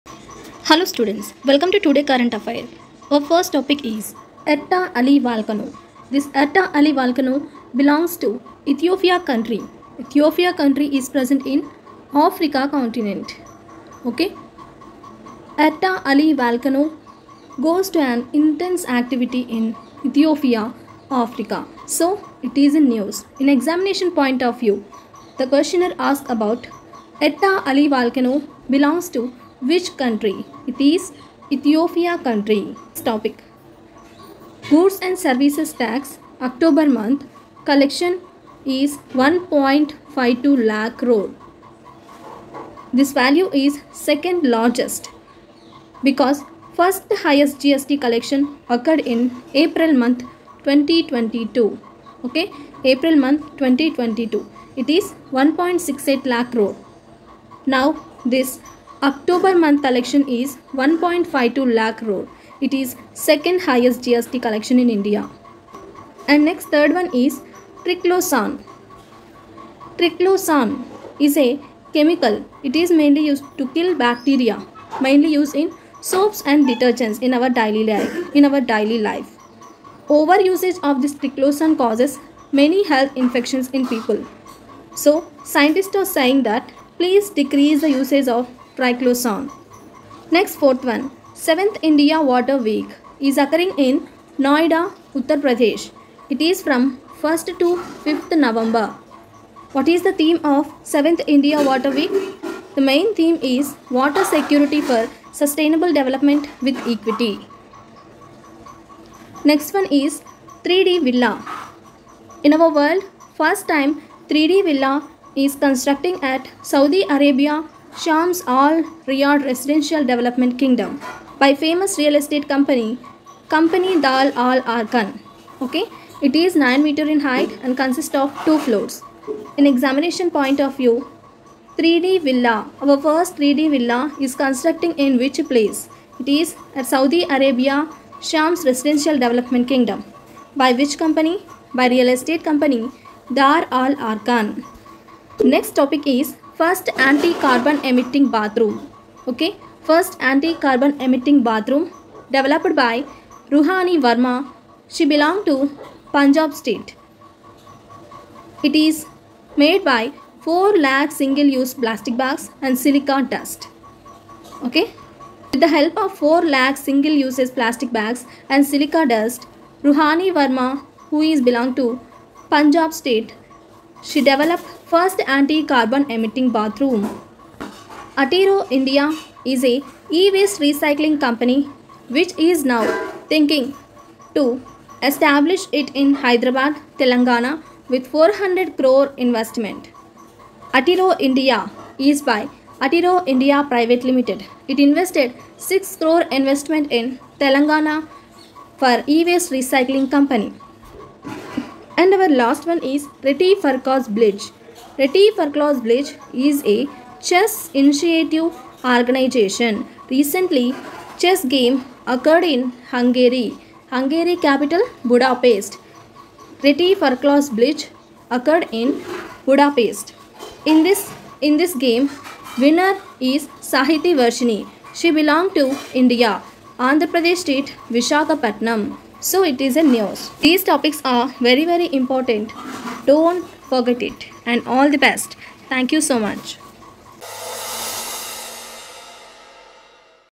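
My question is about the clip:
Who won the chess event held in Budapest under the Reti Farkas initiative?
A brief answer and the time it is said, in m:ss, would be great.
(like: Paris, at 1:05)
Sahiti Varshini, at 3:43.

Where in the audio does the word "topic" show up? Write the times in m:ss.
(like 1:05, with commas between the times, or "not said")
0:03, 0:33, 2:25, 3:50.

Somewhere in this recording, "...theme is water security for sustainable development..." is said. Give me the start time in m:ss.
1:43.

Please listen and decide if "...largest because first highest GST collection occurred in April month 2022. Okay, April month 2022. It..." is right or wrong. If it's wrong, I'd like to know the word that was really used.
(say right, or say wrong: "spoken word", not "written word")
right.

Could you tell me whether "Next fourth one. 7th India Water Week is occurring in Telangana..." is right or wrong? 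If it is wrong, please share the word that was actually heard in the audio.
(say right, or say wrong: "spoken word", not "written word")
wrong: "Noida", not "Telangana".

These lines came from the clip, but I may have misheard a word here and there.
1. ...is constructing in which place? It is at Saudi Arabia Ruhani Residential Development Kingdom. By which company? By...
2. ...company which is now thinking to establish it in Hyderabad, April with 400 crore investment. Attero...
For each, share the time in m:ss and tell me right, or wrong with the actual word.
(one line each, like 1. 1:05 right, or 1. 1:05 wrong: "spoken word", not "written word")
1. 2:14 wrong: "Shams", not "Ruhani"
2. 3:01 wrong: "Telangana", not "April".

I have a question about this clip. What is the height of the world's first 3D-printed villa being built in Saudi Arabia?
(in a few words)
9 meters.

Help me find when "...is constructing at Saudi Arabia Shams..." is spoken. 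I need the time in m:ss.
1:55.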